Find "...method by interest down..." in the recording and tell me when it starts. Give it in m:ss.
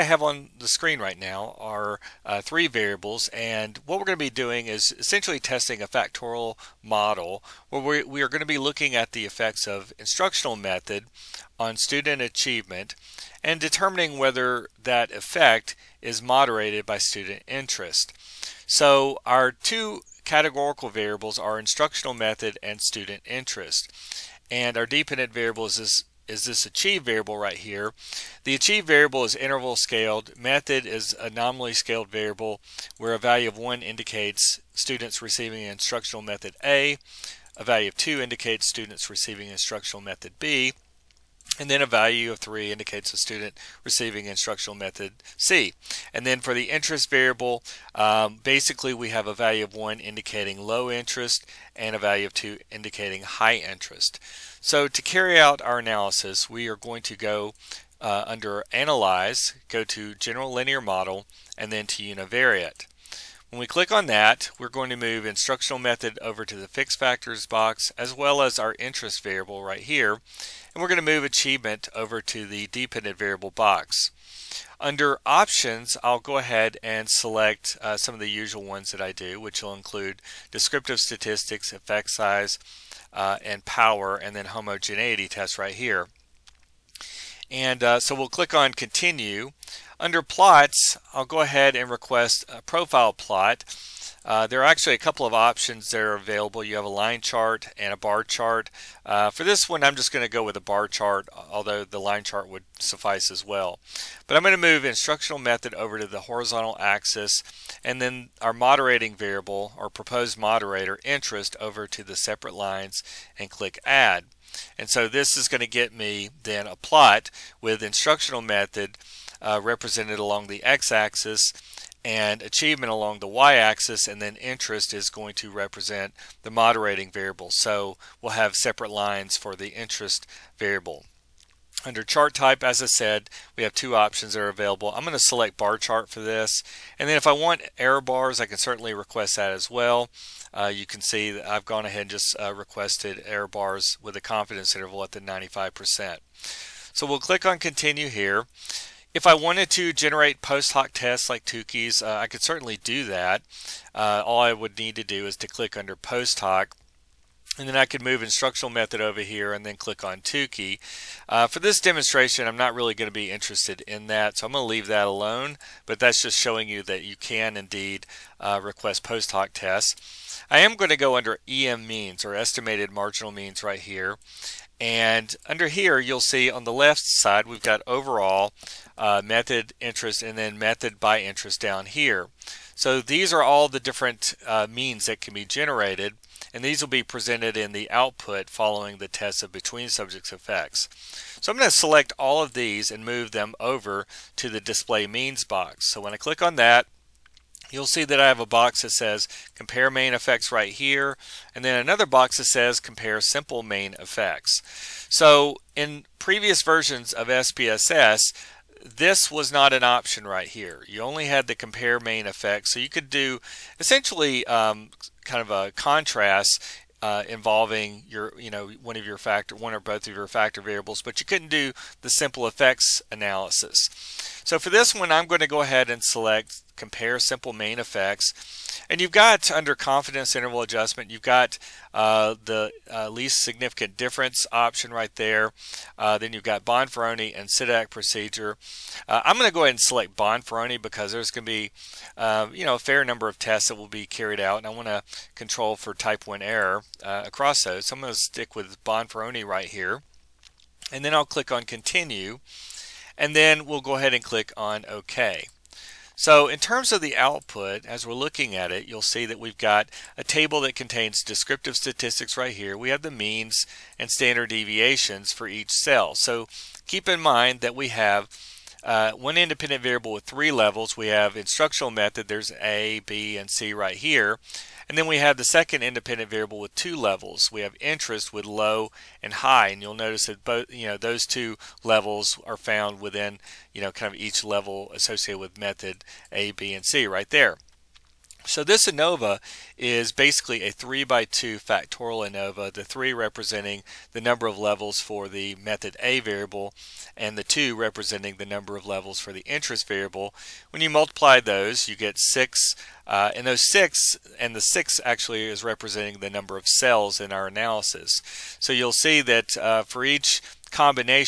3:00.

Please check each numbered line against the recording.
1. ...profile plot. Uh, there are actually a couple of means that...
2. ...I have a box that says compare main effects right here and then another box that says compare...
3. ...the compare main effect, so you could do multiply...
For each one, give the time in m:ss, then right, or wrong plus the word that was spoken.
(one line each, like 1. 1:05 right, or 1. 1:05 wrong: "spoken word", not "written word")
1. 1:32 wrong: "options", not "means"
2. 3:18 right
3. 3:31 wrong: "essentially", not "multiply".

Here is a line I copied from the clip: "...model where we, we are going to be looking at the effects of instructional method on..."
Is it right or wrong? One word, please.
right.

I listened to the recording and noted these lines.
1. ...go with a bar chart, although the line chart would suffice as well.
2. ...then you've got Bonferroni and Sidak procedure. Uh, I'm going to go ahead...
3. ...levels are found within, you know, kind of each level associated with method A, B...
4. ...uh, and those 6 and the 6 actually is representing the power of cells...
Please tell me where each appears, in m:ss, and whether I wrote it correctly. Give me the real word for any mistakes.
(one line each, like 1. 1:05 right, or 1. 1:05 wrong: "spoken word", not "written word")
1. 1:40 right
2. 3:56 right
3. 4:41 right
4. 5:03 wrong: "number", not "power".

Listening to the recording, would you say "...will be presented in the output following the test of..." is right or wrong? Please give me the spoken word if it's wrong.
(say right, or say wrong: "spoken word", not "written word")
right.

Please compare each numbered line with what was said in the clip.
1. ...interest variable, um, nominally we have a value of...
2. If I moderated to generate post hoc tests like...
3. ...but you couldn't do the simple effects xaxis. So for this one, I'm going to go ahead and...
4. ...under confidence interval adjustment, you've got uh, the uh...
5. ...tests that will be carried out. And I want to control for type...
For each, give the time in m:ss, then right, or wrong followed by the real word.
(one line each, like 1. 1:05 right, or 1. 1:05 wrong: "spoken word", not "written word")
1. 0:46 wrong: "basically", not "nominally"
2. 2:29 wrong: "wanted", not "moderated"
3. 3:41 wrong: "analysis", not "xaxis"
4. 3:49 right
5. 4:03 right.